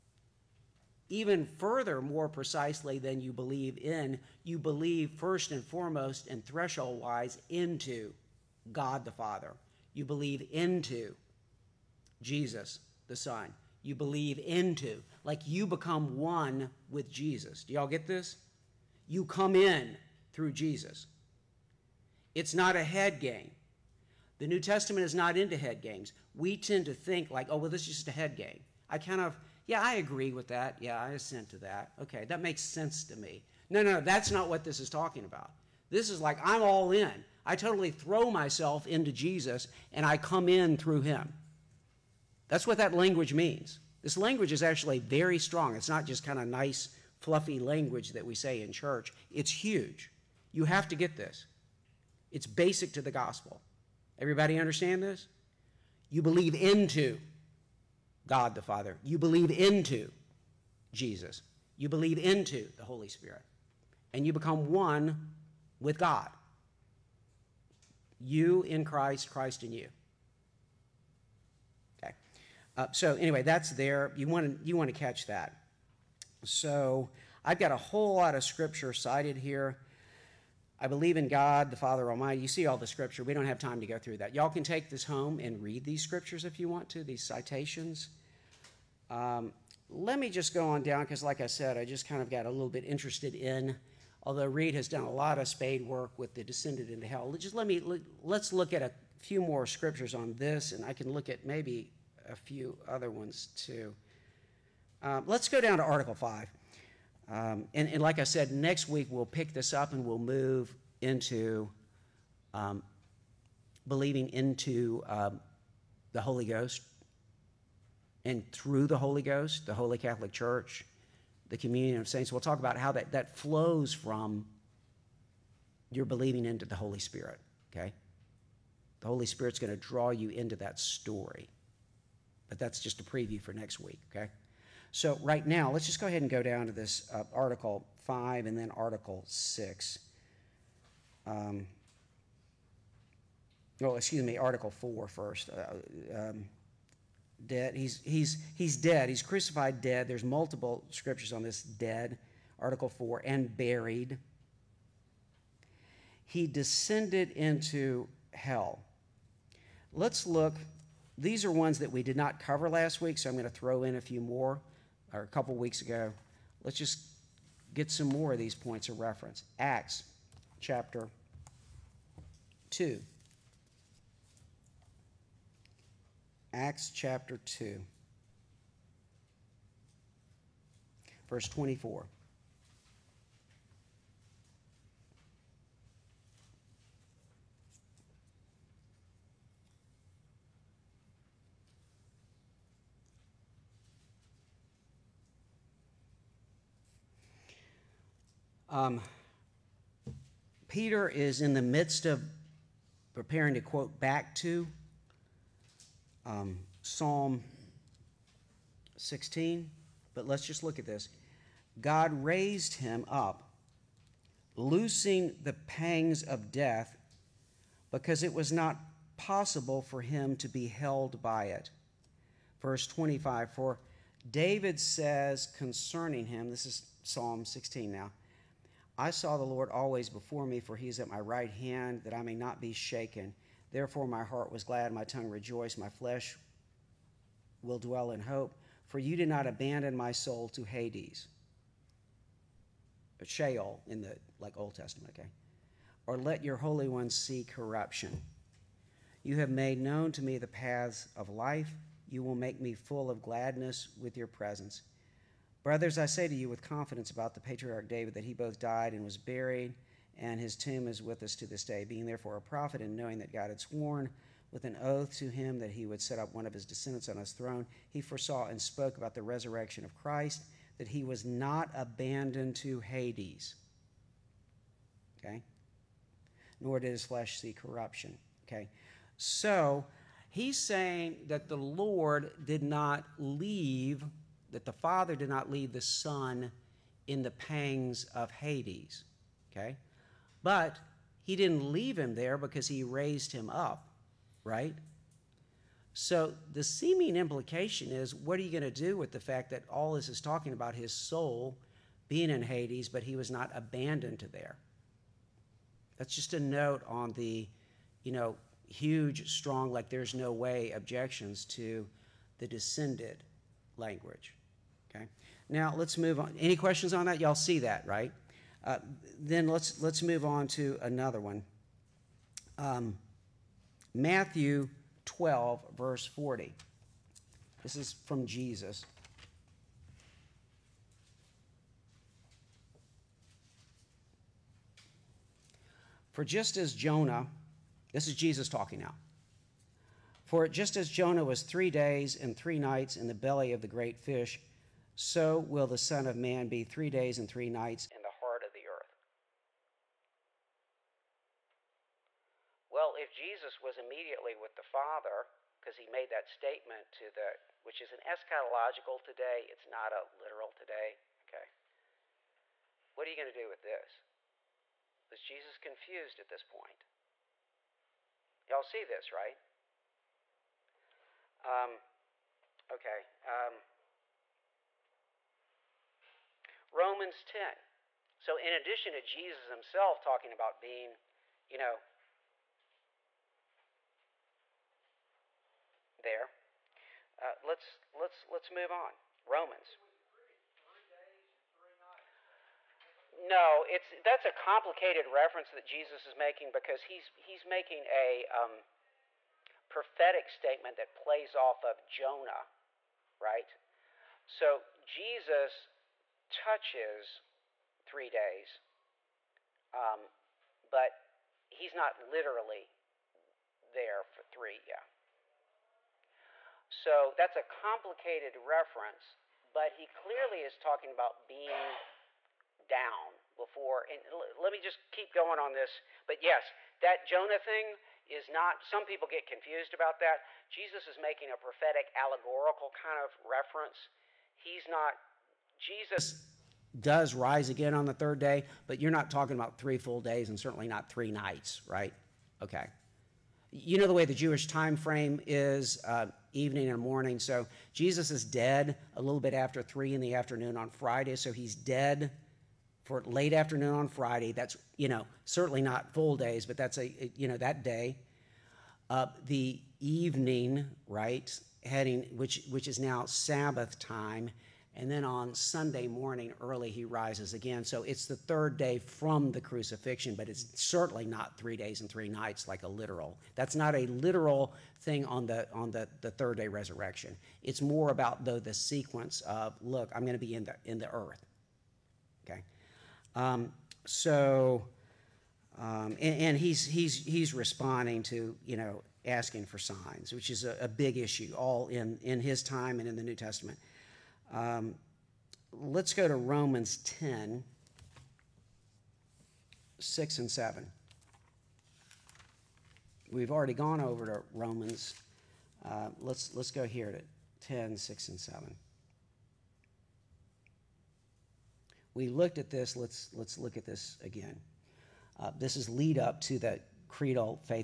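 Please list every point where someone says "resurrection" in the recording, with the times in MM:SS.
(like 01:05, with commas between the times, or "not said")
04:29, 07:56.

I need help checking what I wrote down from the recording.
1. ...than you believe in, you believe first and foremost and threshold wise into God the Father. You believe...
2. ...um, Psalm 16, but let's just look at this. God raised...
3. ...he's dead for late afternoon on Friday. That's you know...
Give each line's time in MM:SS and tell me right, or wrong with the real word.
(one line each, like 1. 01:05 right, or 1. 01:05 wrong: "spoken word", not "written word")
1. 00:02 right
2. 03:26 right
3. 07:31 right.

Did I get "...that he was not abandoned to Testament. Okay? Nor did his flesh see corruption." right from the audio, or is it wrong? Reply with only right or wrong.
wrong.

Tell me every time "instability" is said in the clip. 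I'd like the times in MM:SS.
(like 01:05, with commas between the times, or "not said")
not said.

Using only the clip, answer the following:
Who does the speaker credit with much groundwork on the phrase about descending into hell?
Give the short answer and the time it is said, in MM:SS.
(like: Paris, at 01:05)
Reed, at 01:34.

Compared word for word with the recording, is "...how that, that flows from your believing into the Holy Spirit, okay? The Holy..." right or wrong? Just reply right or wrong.
right.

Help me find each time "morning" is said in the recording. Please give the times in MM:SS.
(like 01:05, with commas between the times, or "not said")
07:26, 07:45.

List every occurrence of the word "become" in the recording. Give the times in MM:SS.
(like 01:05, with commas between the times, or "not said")
00:15, 01:04.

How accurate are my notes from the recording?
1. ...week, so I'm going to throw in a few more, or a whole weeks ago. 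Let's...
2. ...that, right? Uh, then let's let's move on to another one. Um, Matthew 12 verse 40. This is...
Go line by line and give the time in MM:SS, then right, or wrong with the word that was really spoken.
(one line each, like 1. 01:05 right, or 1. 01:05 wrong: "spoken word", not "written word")
1. 02:43 wrong: "couple", not "whole"
2. 05:17 right.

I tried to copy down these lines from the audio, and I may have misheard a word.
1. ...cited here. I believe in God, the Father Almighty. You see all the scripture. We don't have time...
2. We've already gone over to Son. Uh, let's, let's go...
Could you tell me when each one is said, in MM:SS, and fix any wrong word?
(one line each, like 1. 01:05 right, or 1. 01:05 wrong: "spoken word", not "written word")
1. 01:18 right
2. 08:23 wrong: "Romans", not "Son".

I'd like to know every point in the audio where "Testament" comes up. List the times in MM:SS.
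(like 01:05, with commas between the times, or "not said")
00:24, 04:04, 08:13.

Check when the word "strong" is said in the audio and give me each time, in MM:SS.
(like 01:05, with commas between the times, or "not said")
00:45, 05:09.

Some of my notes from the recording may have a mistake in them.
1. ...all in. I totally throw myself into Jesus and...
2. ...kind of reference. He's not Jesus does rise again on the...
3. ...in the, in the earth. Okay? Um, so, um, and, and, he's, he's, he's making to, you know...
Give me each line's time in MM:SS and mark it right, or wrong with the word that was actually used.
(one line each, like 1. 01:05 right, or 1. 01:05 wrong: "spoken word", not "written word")
1. 00:36 right
2. 07:12 right
3. 08:00 wrong: "responding", not "making".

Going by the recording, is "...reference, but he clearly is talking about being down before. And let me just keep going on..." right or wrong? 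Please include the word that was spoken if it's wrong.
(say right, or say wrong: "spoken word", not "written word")
right.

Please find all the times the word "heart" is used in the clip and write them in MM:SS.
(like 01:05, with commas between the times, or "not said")
03:54, 05:48.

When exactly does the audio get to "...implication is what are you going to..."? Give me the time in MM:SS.
04:57.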